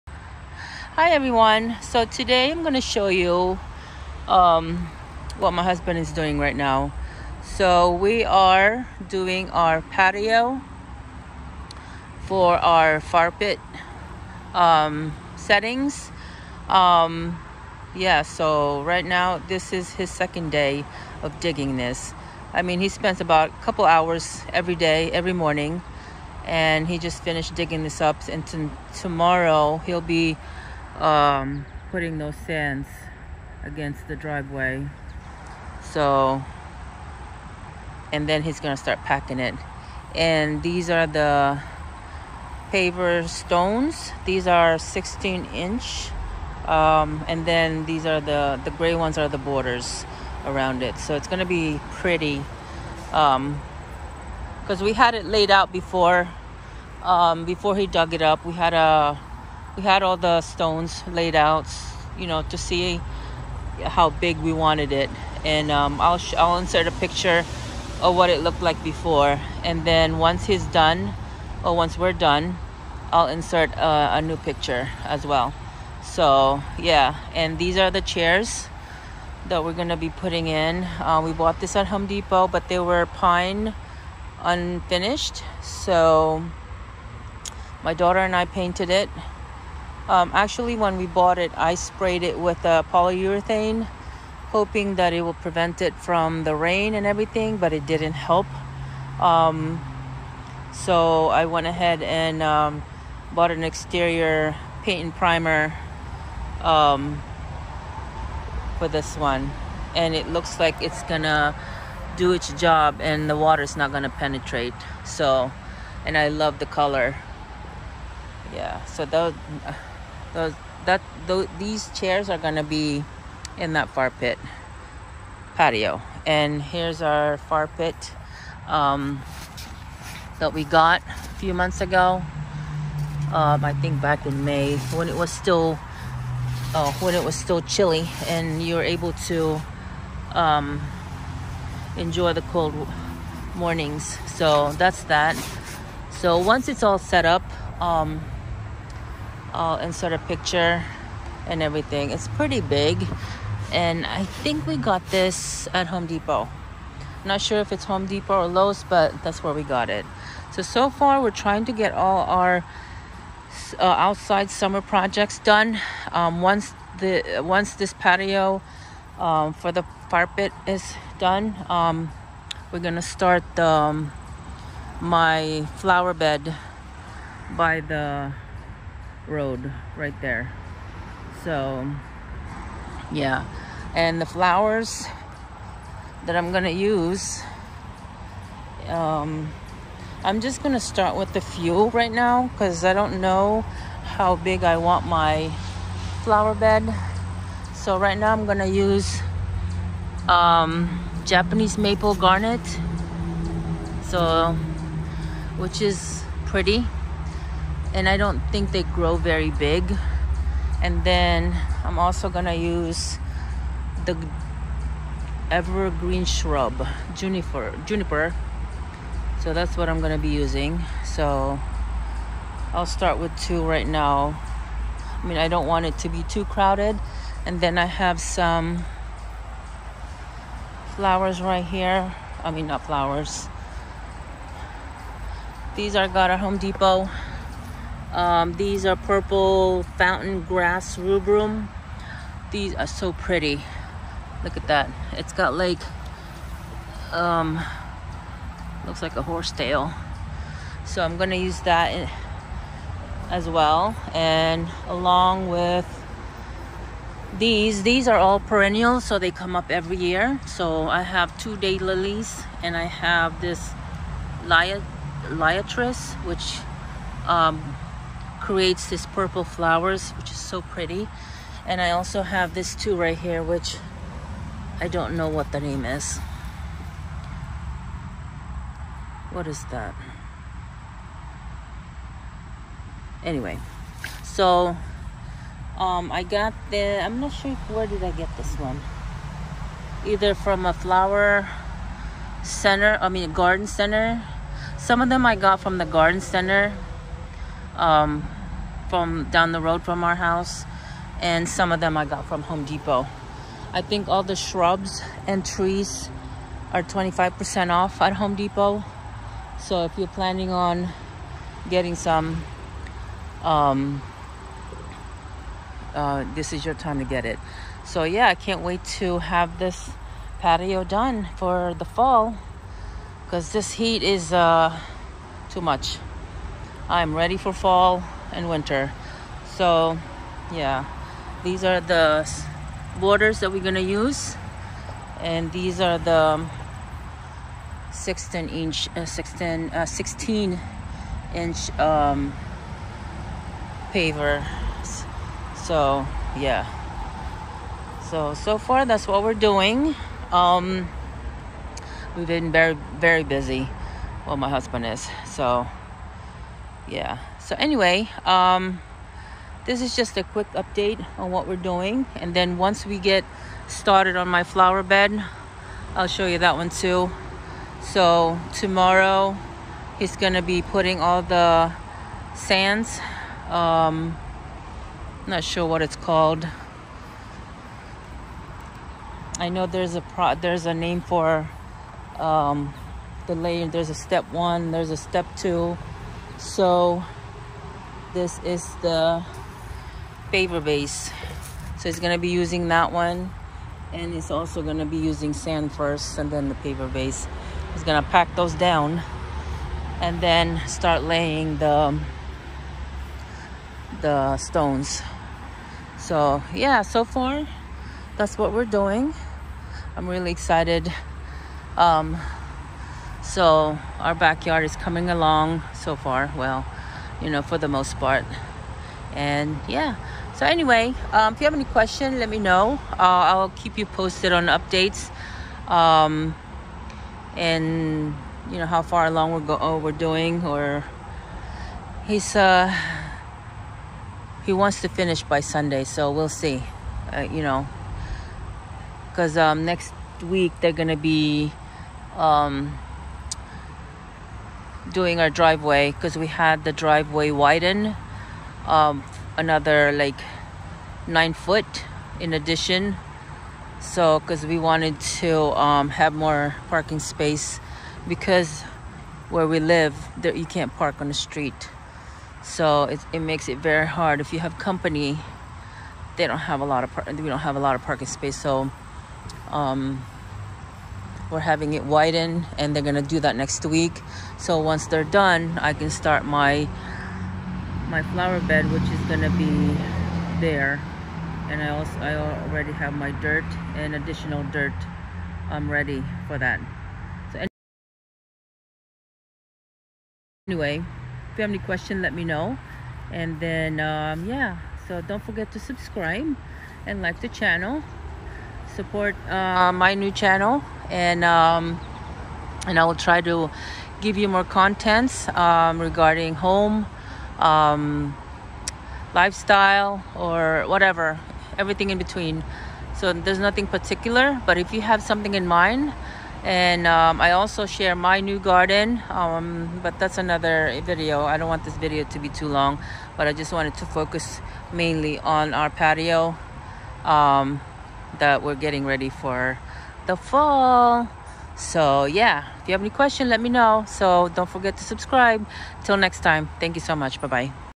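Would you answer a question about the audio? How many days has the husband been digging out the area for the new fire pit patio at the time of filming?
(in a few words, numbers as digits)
2.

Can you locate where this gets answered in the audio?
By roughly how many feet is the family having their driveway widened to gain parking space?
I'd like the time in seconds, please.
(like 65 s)
451 s.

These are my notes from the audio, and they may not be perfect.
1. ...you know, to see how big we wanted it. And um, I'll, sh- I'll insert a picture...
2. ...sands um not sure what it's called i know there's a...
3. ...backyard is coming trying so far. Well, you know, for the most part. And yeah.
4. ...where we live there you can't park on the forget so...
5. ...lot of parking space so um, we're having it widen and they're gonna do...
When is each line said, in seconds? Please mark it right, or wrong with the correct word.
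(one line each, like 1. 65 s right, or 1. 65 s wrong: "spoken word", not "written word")
1. 62 s right
2. 372 s right
3. 414 s wrong: "along", not "trying"
4. 459 s wrong: "street", not "forget"
5. 467 s right.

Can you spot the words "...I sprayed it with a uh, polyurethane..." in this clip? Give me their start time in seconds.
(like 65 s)
91 s.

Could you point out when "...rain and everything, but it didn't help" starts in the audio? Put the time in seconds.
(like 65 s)
96 s.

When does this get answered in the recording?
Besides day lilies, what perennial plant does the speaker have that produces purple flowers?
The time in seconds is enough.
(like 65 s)
264 s.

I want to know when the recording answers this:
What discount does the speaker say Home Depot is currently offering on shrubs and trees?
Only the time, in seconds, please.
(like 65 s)
306 s.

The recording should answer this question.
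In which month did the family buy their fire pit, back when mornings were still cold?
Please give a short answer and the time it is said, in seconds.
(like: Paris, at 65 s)
May, at 134 s.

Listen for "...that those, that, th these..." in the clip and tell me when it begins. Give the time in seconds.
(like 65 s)
119 s.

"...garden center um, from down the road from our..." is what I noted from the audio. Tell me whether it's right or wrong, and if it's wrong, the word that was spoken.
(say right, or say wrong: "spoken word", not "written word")
right.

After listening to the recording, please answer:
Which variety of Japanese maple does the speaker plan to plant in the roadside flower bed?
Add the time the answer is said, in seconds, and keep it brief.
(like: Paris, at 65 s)
Garnet, at 202 s.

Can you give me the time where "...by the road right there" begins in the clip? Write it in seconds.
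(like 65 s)
177 s.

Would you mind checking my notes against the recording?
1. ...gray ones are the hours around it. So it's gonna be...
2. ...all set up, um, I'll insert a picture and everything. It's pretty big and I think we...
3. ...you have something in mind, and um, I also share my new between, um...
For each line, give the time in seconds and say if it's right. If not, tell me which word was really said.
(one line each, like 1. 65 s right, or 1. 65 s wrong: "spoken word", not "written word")
1. 48 s wrong: "borders", not "hours"
2. 146 s right
3. 514 s wrong: "garden", not "between".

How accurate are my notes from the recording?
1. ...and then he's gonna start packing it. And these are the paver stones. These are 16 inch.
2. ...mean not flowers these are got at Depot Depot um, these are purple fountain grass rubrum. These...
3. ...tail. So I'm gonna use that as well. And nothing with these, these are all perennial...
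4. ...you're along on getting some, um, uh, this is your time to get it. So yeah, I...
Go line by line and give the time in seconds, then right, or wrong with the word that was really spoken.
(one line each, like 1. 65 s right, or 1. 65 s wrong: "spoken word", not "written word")
1. 38 s right
2. 232 s wrong: "Home", not "Depot"
3. 249 s wrong: "along", not "nothing"
4. 309 s wrong: "planning", not "along".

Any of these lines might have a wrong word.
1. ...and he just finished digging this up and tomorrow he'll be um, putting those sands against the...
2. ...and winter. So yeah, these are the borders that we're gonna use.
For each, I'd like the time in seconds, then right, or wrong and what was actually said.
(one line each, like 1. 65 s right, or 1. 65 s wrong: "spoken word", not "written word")
1. 26 s right
2. 328 s right.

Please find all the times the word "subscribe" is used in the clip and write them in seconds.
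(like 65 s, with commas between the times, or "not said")
495 s, 534 s.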